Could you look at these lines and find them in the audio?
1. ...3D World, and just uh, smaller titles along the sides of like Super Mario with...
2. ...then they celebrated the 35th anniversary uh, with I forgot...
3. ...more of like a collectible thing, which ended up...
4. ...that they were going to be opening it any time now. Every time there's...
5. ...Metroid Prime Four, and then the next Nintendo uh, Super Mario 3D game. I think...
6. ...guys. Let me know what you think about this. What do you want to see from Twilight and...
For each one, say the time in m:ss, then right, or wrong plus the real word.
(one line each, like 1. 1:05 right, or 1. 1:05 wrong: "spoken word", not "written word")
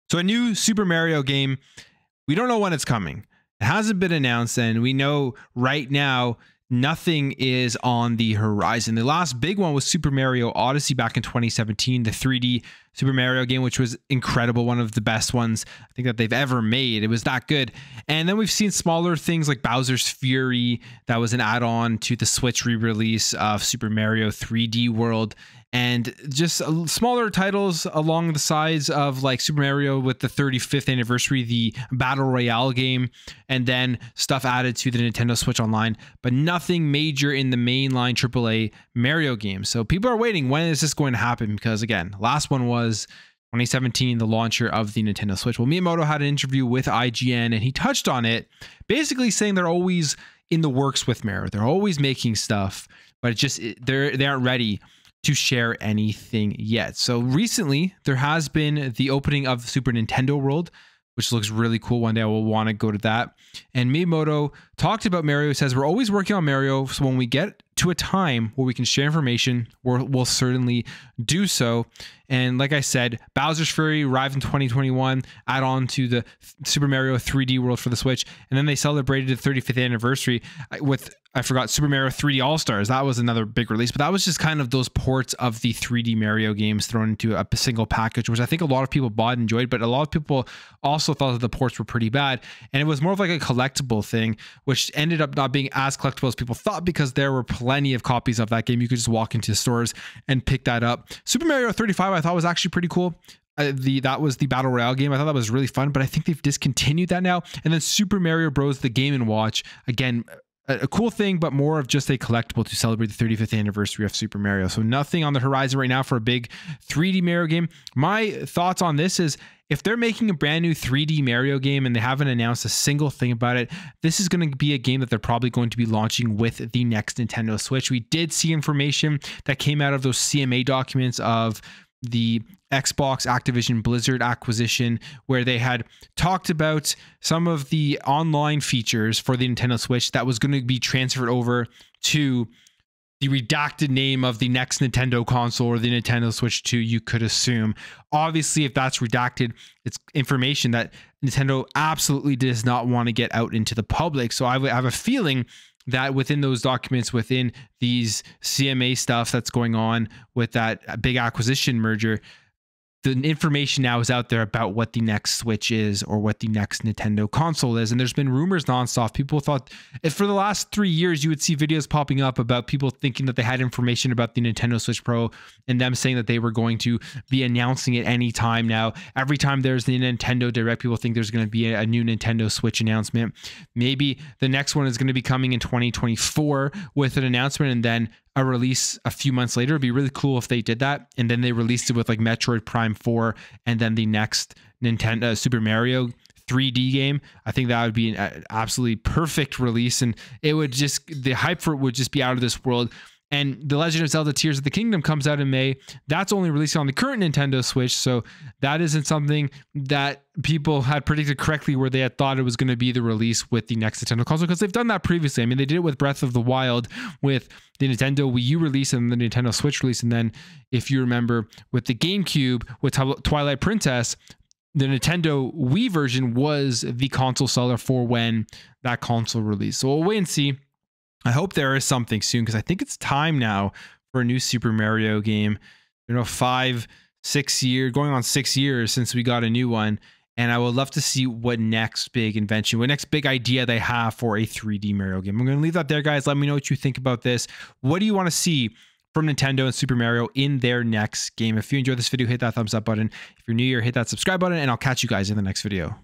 1. 0:24 right
2. 1:18 right
3. 1:33 right
4. 2:56 wrong: "announcing", not "opening"
5. 3:12 right
6. 4:06 wrong: "Nintendo", not "Twilight".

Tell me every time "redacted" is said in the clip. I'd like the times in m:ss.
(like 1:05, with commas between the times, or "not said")
2:23, 2:28.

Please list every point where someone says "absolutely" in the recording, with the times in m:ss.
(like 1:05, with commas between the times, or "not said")
2:31, 3:18.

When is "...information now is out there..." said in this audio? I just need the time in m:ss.
2:43.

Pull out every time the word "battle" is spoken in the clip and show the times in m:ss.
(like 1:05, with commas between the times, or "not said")
0:31, 1:44.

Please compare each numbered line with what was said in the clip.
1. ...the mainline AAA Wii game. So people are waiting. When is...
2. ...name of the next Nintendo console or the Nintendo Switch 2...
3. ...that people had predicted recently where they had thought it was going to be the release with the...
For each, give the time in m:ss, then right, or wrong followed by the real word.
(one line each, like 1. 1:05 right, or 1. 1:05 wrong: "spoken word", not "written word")
1. 0:37 wrong: "Mario", not "Wii"
2. 2:23 right
3. 3:29 wrong: "correctly", not "recently".